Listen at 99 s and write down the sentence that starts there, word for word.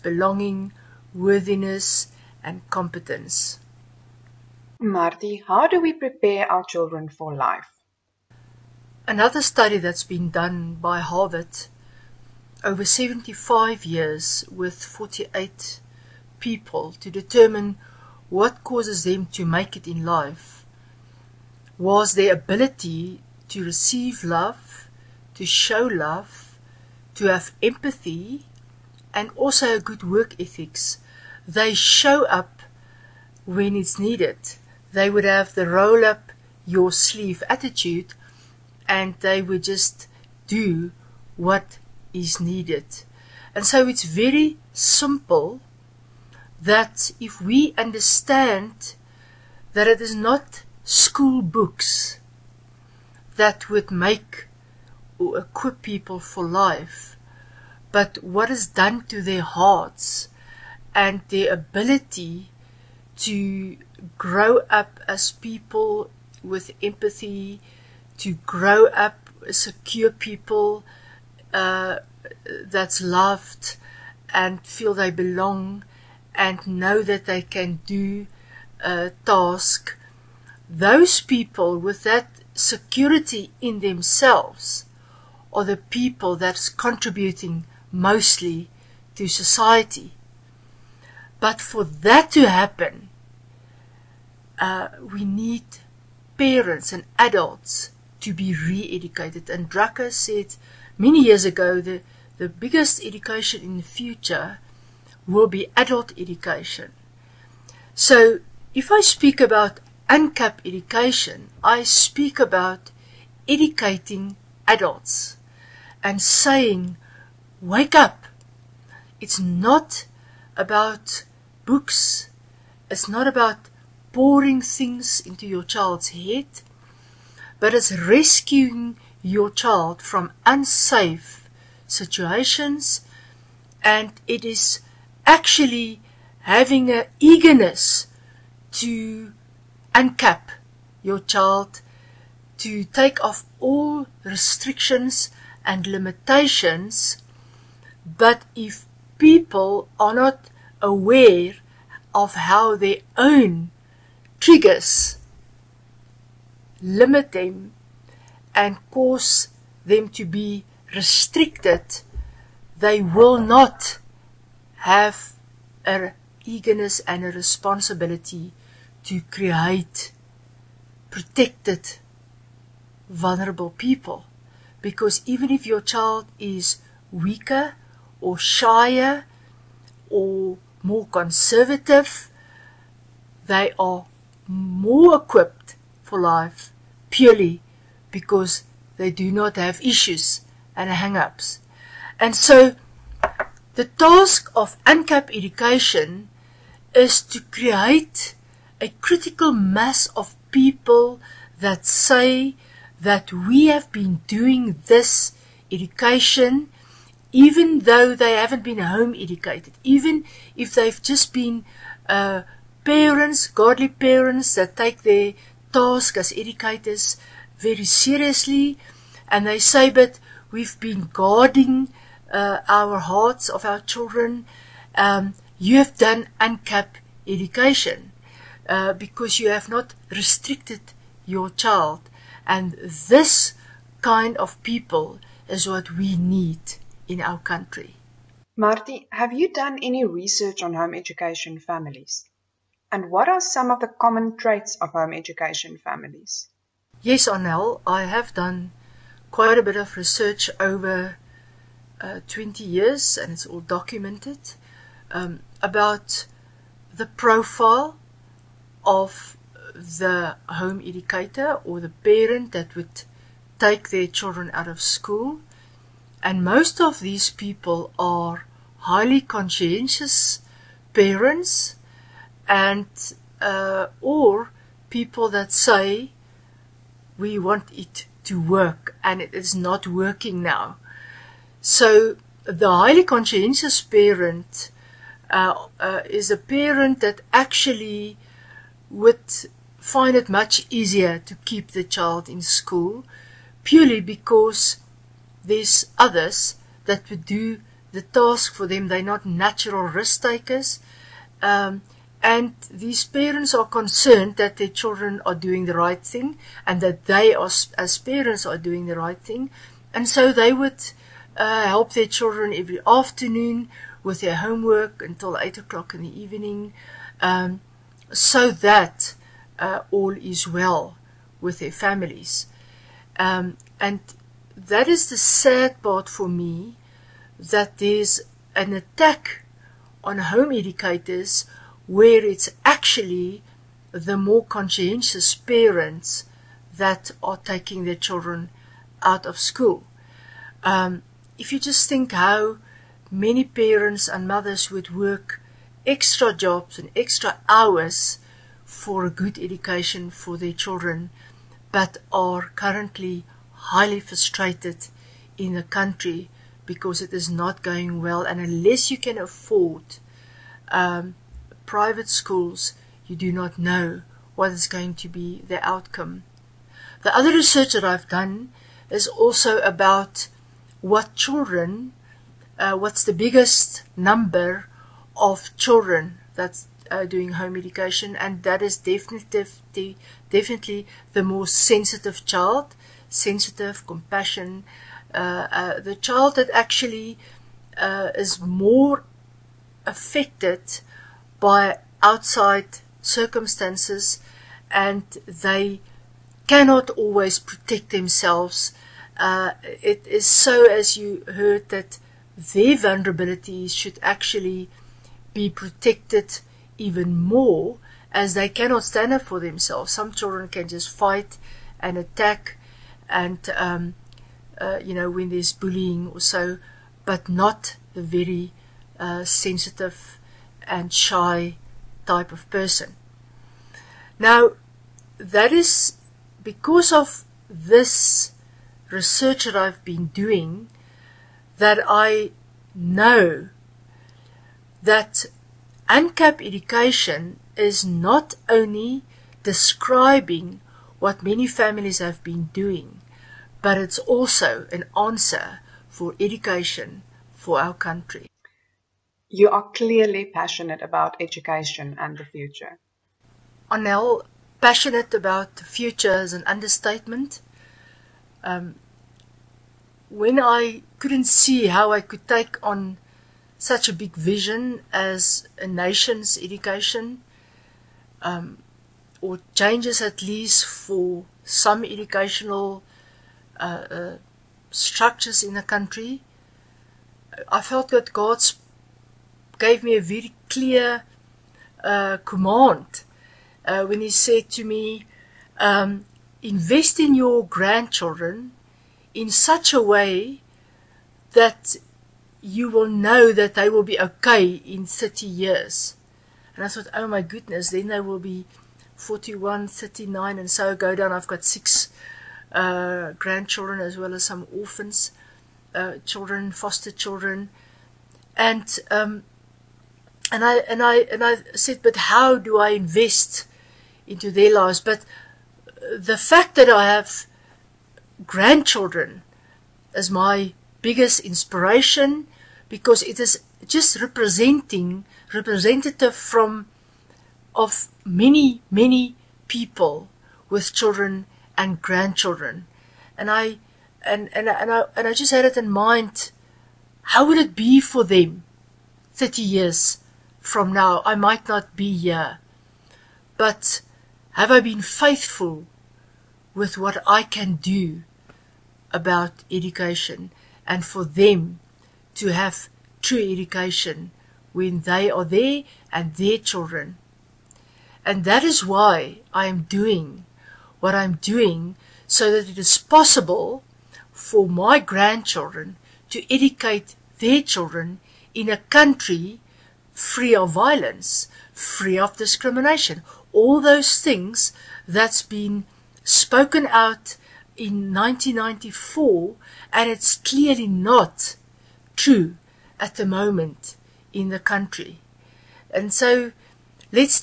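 And Drucker said many years ago the, the biggest education in the future will be adult education.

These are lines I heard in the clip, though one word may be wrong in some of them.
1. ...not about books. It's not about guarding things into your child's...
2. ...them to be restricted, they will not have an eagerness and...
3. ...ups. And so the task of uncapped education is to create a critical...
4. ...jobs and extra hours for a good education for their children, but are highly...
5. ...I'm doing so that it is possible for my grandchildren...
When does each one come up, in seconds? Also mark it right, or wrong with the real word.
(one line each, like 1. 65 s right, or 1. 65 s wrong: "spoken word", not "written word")
1. 119 s wrong: "pouring", not "guarding"
2. 159 s right
3. 191 s right
4. 346 s wrong: "currently", not "highly"
5. 560 s right.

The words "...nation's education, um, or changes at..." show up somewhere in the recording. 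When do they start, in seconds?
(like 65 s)
465 s.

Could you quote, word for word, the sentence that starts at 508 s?
And um, and I and I and I said, but how do I invest into their lives?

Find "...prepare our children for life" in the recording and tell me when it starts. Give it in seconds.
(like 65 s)
5 s.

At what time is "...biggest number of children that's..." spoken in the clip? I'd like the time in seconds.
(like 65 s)
373 s.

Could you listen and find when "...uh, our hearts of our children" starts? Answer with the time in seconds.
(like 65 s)
222 s.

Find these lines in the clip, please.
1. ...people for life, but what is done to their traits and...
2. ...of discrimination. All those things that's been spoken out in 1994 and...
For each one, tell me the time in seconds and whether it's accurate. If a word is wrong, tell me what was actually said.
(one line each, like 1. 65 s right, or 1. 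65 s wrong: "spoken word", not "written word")
1. 55 s wrong: "hearts", not "traits"
2. 571 s right.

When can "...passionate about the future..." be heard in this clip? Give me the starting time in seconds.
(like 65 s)
454 s.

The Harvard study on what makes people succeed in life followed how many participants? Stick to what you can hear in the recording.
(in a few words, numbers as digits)
48.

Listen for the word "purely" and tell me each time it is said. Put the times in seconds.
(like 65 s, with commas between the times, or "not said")
187 s, 293 s.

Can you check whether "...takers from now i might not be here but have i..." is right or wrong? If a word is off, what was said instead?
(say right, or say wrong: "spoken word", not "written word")
wrong: "years", not "takers".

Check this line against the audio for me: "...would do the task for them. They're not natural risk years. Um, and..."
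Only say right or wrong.
wrong.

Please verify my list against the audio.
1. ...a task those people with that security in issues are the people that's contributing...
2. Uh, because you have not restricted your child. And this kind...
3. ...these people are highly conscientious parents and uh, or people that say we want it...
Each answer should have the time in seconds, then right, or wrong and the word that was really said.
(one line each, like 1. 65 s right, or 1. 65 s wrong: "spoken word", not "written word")
1. 78 s wrong: "themselves", not "issues"
2. 228 s right
3. 266 s right.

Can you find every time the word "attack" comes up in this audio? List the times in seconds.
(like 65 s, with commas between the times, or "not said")
328 s, 411 s.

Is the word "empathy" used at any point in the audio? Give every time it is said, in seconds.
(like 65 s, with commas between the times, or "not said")
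27 s, 66 s.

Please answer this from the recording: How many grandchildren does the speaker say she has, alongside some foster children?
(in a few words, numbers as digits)
6.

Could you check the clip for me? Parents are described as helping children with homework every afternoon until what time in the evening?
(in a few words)
8 o'clock.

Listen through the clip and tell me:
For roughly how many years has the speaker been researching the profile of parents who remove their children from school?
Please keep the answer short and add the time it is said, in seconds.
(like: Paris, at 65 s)
20 years, at 252 s.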